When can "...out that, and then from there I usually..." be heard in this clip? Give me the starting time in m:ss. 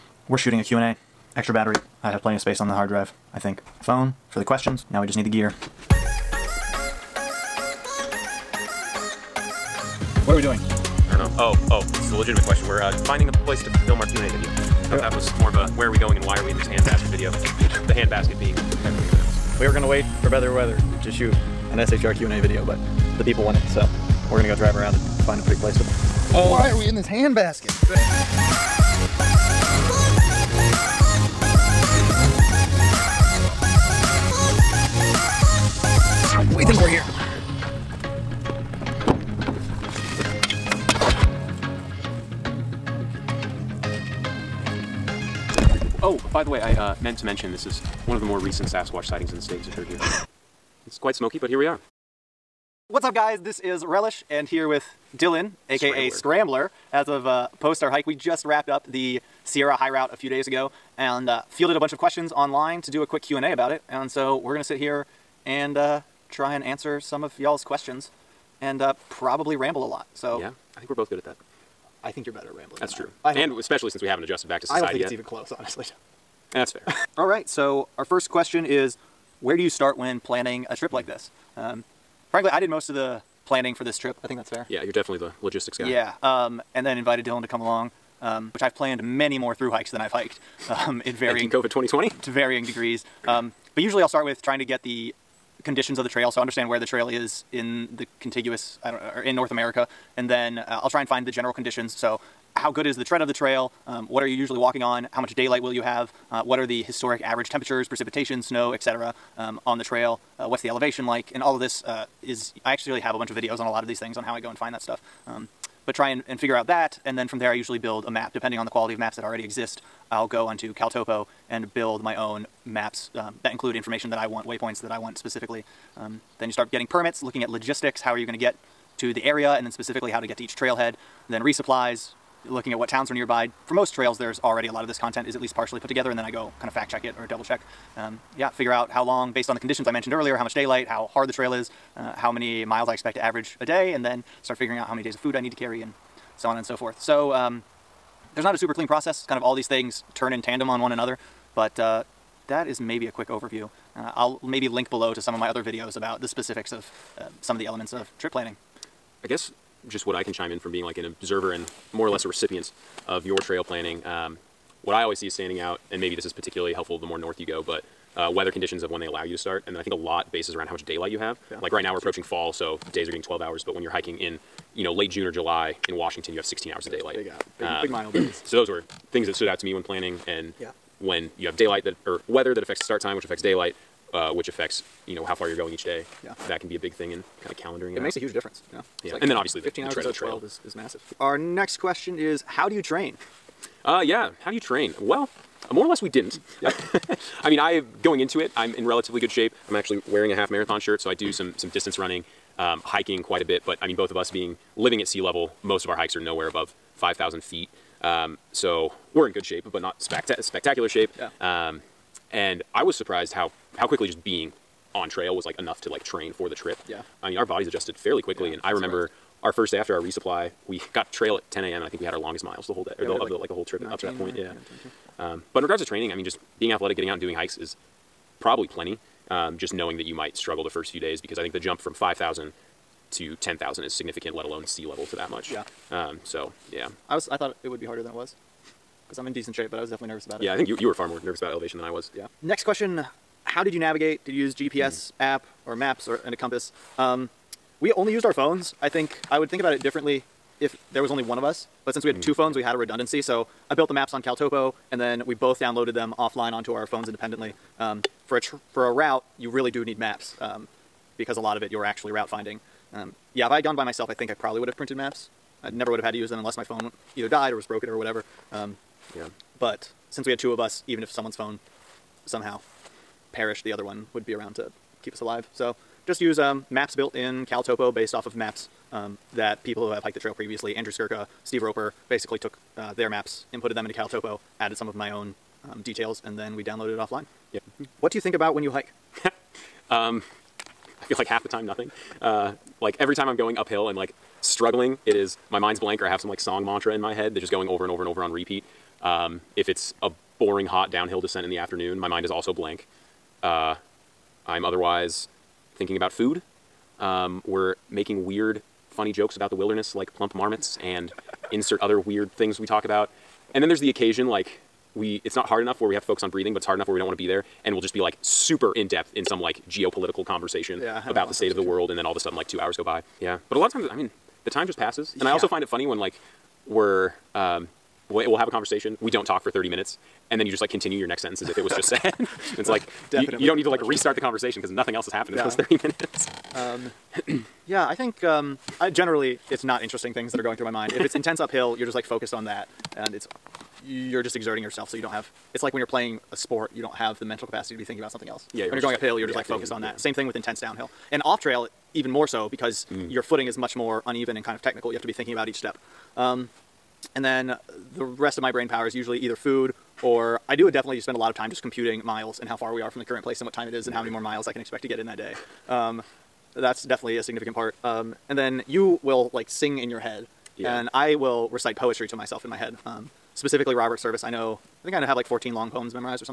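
1:56.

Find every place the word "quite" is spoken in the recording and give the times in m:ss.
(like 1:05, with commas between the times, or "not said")
0:51, 3:23.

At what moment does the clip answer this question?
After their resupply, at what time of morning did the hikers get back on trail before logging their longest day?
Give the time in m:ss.
3:41.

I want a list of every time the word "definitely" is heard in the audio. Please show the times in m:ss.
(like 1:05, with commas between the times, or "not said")
1:24, 3:59, 5:33, 6:00, 6:06.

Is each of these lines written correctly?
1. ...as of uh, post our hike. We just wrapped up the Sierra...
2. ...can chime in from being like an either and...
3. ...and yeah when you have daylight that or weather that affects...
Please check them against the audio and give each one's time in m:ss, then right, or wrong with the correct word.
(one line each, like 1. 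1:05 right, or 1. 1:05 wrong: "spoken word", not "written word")
1. 0:56 right
2. 2:40 wrong: "observer", not "either"
3. 3:00 right.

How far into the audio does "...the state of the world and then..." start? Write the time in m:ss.
5:21.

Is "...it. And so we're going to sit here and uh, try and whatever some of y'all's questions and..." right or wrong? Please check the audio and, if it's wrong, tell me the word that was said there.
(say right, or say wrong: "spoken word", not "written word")
wrong: "answer", not "whatever".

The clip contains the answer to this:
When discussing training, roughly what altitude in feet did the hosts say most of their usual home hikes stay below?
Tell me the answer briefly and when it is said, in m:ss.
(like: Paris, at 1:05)
5,000 feet, at 3:26.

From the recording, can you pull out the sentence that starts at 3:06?
Yeah, that can be a big thing in kind of calendaring it.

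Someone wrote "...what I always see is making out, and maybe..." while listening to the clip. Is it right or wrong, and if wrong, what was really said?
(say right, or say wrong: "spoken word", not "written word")
wrong: "standing", not "making".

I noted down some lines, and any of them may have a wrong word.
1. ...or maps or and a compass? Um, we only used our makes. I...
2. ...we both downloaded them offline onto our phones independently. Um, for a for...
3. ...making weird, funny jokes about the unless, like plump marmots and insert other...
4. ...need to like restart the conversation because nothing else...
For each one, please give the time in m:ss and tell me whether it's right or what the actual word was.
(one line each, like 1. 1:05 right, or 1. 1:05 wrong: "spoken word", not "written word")
1. 4:05 wrong: "phones", not "makes"
2. 4:15 right
3. 5:07 wrong: "wilderness", not "unless"
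4. 5:33 right.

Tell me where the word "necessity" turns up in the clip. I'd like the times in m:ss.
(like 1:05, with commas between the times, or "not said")
not said.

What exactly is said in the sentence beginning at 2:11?
Then resupplies, looking at what towns are nearby.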